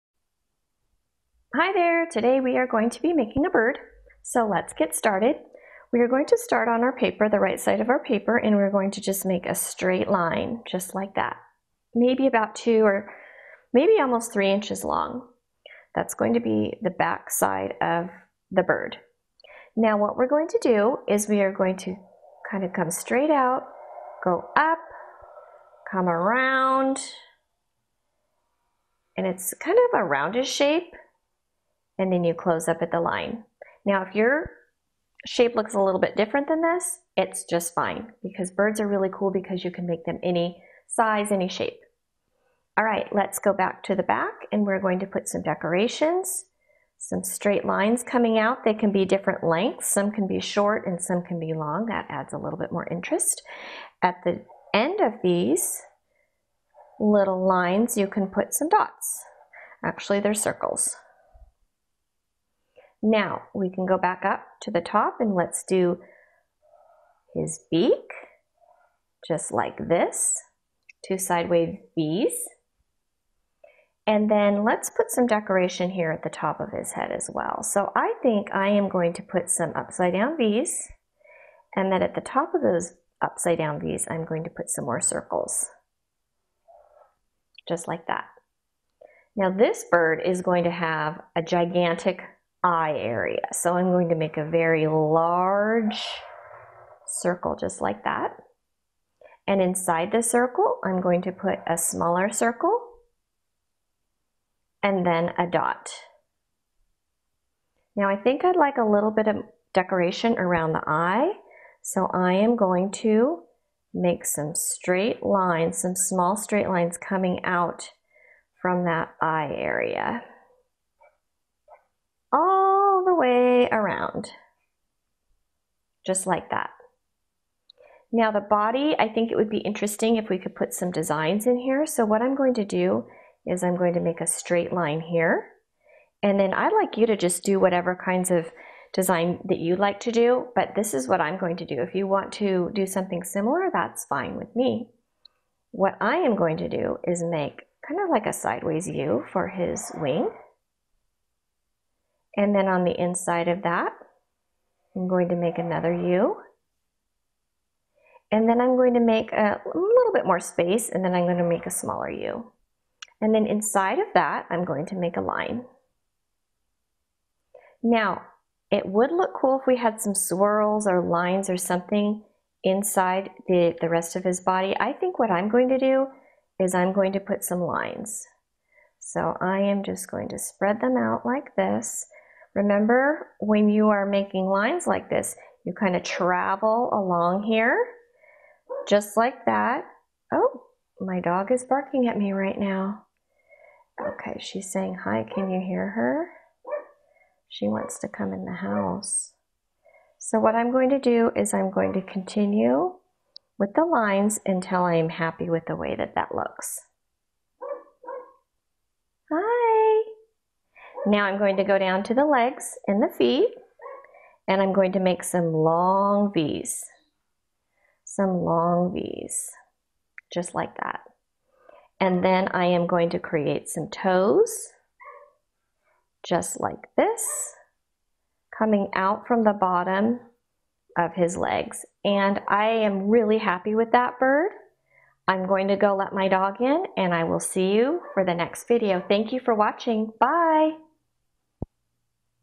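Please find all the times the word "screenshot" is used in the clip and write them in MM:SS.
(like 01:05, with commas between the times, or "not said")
not said.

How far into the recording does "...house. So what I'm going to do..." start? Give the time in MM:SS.
03:18.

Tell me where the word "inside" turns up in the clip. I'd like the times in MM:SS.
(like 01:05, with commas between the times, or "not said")
01:39, 02:33, 02:43, 02:52.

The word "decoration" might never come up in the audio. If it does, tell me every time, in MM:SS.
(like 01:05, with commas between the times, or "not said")
00:45, 01:15, 01:49.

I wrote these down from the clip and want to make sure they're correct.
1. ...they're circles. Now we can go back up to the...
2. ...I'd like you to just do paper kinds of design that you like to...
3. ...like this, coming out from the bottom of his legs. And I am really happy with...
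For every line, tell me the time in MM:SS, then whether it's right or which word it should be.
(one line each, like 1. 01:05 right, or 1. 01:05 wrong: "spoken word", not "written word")
1. 01:00 right
2. 02:16 wrong: "whatever", not "paper"
3. 03:46 right.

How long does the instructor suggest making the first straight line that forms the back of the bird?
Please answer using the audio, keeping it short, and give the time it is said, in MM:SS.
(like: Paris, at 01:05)
almost 3 inches, at 00:13.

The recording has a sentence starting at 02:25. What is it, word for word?
What I am going to do is make kind of like a sideways U for his wing.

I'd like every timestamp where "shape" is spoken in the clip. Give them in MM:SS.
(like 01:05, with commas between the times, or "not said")
00:30, 00:35, 00:41.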